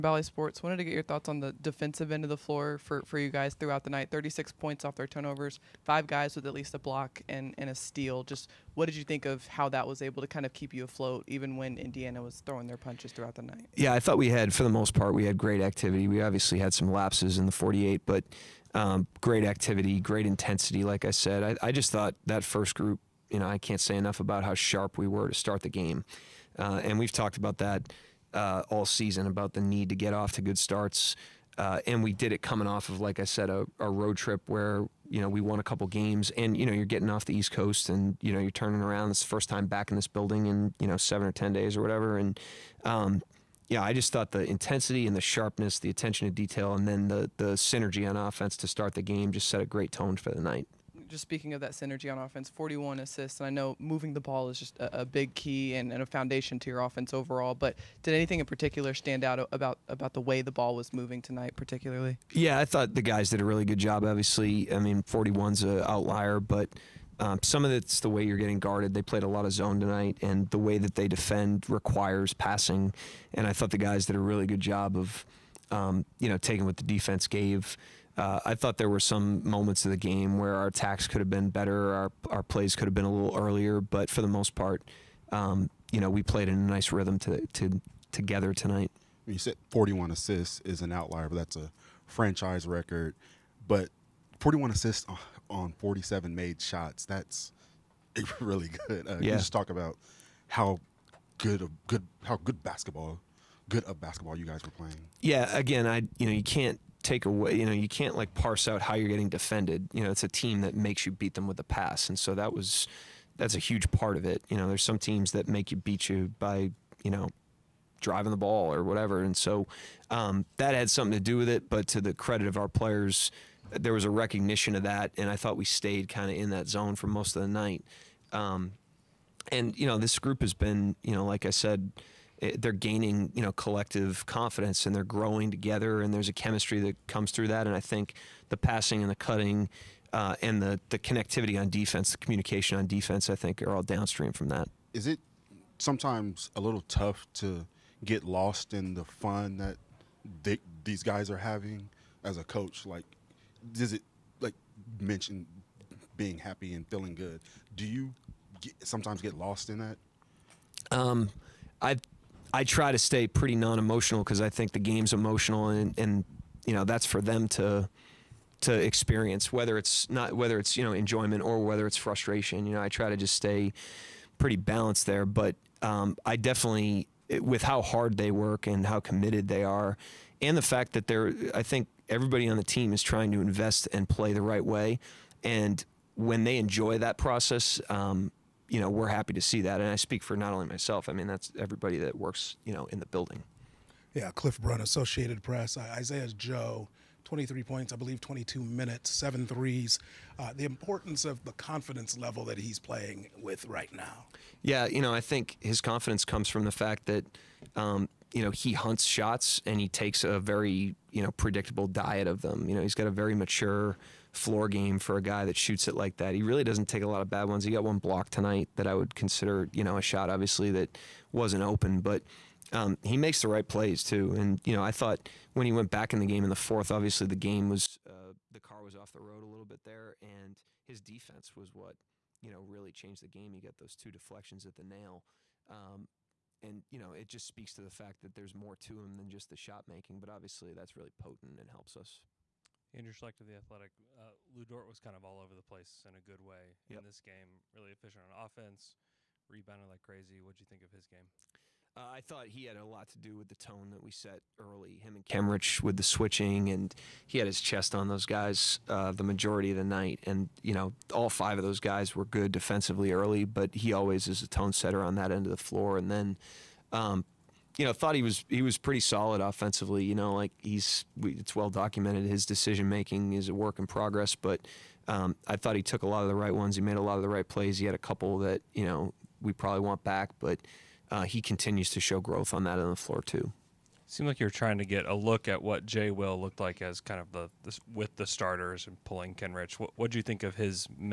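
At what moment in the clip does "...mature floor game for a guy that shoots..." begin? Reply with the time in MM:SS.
03:33.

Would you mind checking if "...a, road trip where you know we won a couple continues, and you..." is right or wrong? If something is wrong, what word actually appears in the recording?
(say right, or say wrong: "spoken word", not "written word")
wrong: "games", not "continues".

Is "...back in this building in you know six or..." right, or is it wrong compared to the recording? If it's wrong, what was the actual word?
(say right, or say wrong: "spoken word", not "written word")
wrong: "seven", not "six".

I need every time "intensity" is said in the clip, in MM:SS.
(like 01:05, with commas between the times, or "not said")
00:20, 00:44.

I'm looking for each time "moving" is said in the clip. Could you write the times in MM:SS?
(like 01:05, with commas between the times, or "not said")
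00:53, 01:00.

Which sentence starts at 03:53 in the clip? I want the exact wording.
He got those two deflections at the nail.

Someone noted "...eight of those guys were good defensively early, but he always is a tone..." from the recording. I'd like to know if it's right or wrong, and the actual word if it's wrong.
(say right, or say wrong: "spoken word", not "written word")
wrong: "five", not "eight".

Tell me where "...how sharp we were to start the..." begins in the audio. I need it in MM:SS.
00:24.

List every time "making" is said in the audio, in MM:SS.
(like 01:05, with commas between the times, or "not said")
03:59, 04:32.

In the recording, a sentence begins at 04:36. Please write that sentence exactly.
He made a lot of the right plays.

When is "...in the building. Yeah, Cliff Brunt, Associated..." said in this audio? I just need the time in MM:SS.
03:12.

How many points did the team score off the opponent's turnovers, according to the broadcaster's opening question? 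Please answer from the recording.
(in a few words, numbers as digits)
36.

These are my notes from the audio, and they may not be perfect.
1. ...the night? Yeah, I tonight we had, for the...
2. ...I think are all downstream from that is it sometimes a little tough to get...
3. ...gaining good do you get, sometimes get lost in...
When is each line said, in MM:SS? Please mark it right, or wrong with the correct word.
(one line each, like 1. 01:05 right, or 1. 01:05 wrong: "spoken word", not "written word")
1. 00:13 wrong: "thought", not "tonight"
2. 02:23 right
3. 02:36 wrong: "feeling", not "gaining".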